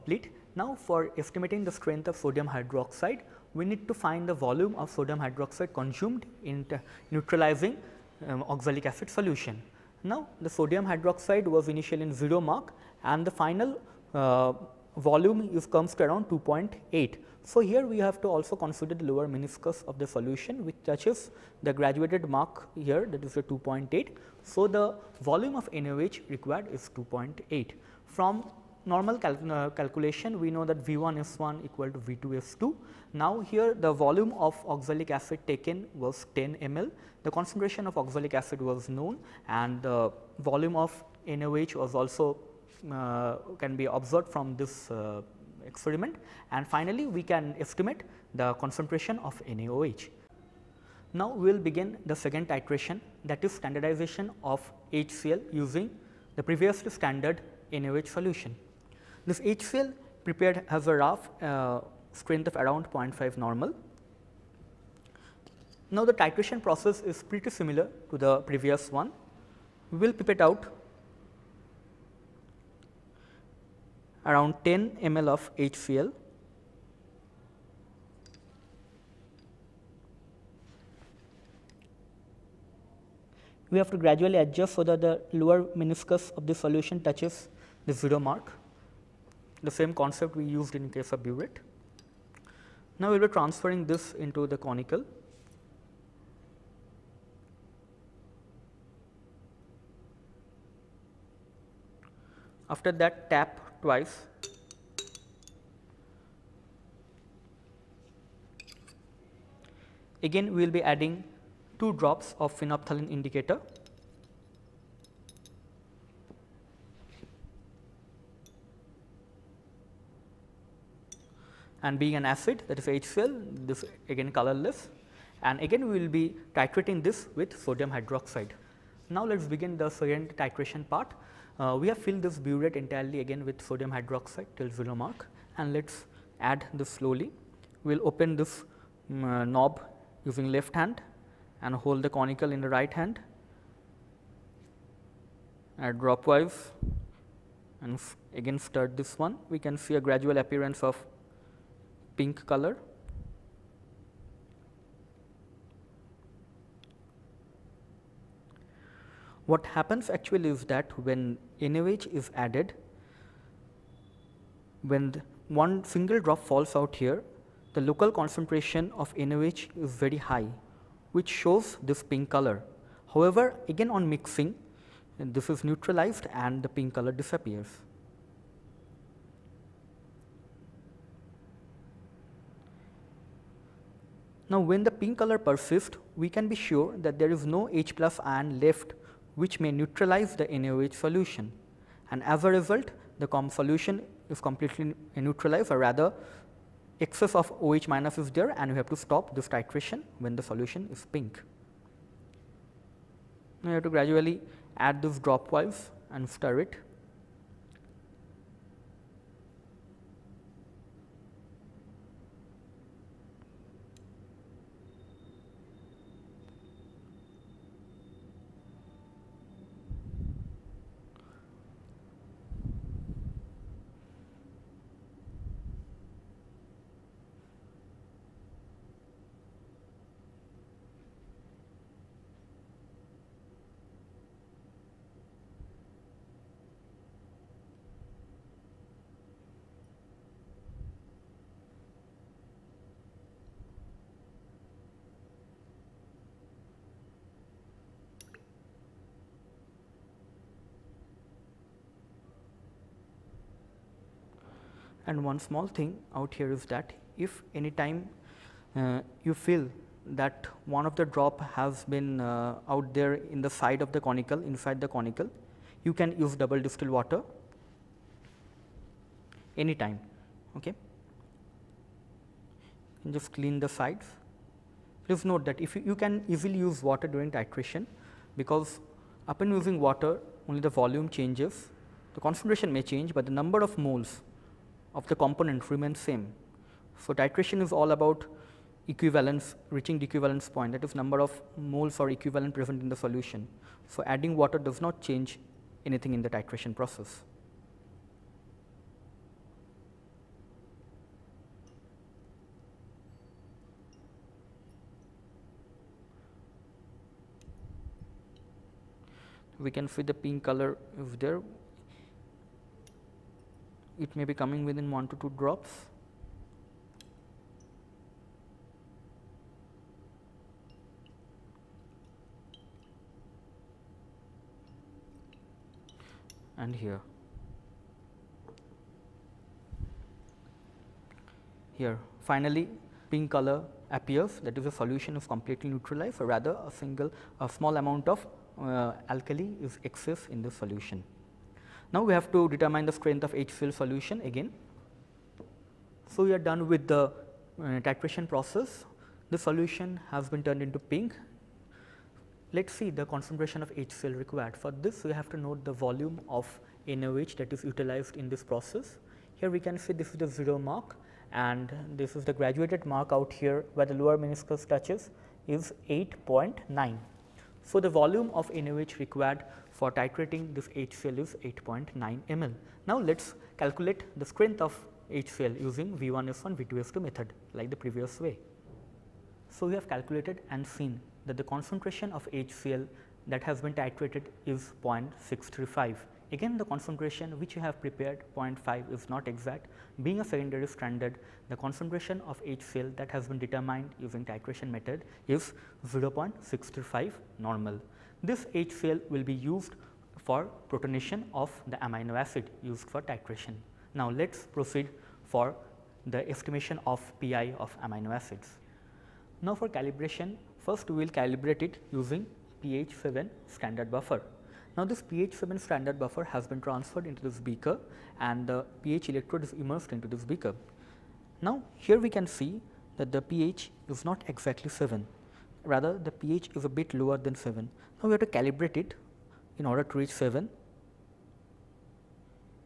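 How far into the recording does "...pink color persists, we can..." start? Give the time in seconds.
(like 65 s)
184 s.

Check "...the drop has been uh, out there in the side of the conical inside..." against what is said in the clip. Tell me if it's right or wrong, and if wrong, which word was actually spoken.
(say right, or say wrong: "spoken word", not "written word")
right.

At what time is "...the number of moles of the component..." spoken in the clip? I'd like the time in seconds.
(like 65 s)
283 s.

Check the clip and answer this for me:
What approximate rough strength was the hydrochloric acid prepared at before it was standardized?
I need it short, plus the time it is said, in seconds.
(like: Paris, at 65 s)
0.5 normal, at 62 s.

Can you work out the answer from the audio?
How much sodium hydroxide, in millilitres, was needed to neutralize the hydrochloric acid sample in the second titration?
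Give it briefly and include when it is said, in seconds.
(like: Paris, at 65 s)
8.9 ml, at 371 s.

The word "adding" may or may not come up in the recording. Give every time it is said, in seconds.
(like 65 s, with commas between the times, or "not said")
110 s, 294 s.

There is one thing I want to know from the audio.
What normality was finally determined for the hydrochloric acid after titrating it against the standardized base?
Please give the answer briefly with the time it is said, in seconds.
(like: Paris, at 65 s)
0.635 normal, at 395 s.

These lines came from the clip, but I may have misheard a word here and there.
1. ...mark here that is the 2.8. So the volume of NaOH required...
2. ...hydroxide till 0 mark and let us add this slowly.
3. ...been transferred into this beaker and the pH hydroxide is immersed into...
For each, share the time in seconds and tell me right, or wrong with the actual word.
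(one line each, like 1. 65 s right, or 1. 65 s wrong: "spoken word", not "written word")
1. 22 s right
2. 133 s right
3. 416 s wrong: "electrode", not "hydroxide".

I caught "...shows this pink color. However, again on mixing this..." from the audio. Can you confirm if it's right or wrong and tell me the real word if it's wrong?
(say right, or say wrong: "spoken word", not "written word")
right.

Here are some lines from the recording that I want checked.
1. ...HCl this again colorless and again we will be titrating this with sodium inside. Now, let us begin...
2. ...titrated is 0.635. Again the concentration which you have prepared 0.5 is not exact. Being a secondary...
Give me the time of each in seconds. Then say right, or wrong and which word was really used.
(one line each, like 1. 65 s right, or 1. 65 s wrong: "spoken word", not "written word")
1. 122 s wrong: "hydroxide", not "inside"
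2. 383 s right.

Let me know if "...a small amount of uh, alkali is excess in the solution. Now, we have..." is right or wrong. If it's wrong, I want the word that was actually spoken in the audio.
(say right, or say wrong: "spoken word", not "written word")
right.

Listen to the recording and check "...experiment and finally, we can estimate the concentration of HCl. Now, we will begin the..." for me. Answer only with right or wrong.
wrong.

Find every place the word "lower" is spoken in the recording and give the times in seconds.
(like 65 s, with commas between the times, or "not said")
19 s, 85 s, 363 s, 426 s.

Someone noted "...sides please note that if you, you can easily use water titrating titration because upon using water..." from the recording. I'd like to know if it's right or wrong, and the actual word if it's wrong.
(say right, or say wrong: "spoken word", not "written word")
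wrong: "during", not "titrating".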